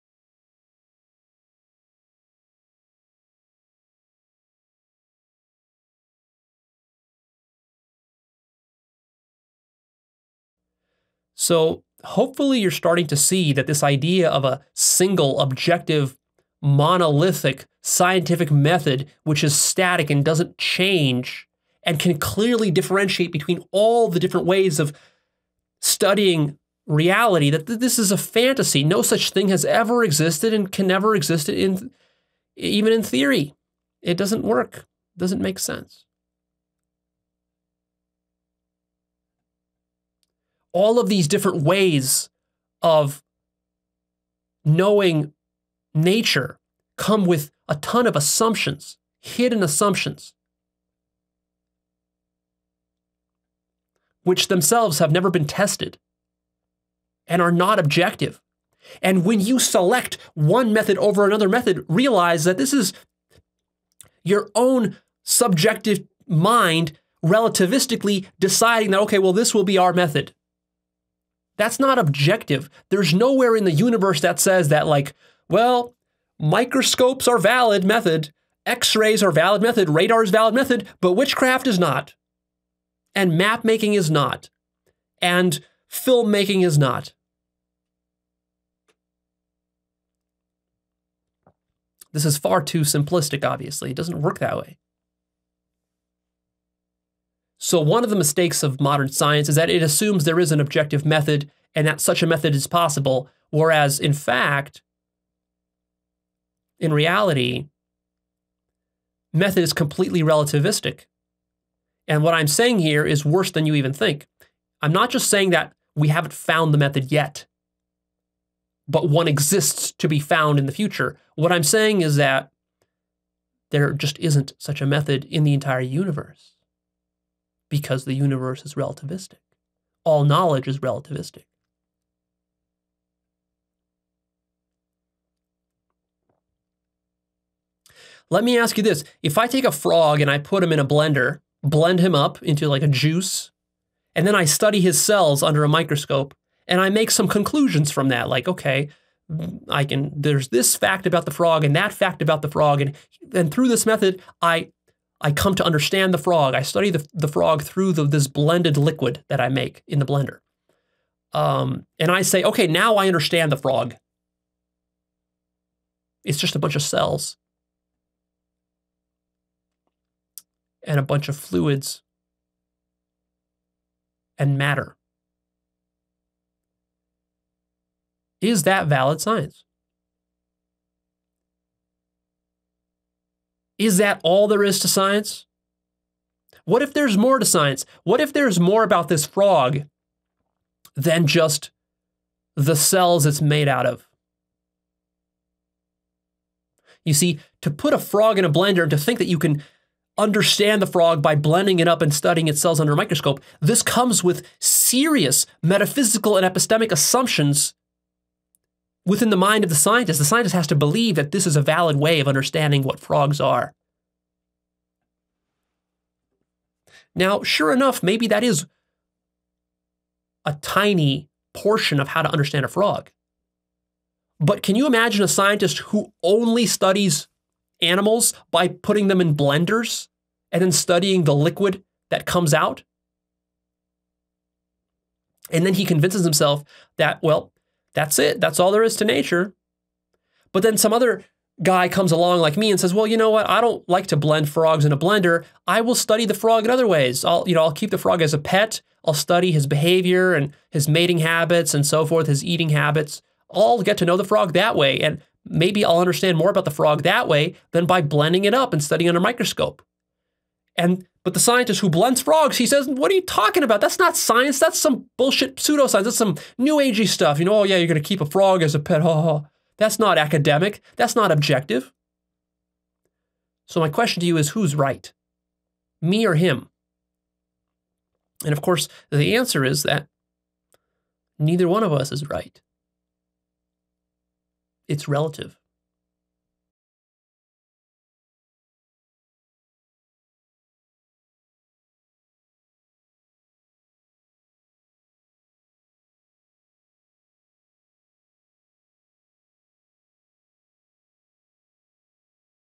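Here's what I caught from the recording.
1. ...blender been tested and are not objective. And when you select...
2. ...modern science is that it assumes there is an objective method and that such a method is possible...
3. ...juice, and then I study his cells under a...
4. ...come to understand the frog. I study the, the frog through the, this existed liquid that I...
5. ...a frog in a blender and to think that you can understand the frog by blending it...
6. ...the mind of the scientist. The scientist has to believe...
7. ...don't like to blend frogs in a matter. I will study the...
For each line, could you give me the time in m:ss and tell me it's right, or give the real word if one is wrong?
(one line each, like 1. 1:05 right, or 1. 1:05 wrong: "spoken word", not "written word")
1. 0:55 wrong: "never", not "blender"
2. 1:38 right
3. 2:22 right
4. 2:35 wrong: "blended", not "existed"
5. 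3:17 right
6. 3:29 right
7. 4:03 wrong: "blender", not "matter".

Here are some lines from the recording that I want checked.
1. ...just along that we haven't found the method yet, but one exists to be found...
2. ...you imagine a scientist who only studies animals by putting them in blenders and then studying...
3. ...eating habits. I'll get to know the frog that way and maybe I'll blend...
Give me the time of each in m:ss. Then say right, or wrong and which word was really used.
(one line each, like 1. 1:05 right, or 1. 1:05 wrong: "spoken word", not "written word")
1. 1:55 wrong: "saying", not "along"
2. 3:44 right
3. 4:12 wrong: "understand", not "blend".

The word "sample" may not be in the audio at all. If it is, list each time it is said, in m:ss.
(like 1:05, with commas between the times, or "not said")
not said.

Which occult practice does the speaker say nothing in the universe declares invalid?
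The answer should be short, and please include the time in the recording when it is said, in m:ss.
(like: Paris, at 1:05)
witchcraft, at 1:21.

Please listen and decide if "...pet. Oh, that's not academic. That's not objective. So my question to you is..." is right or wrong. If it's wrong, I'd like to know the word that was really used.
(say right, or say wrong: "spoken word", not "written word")
right.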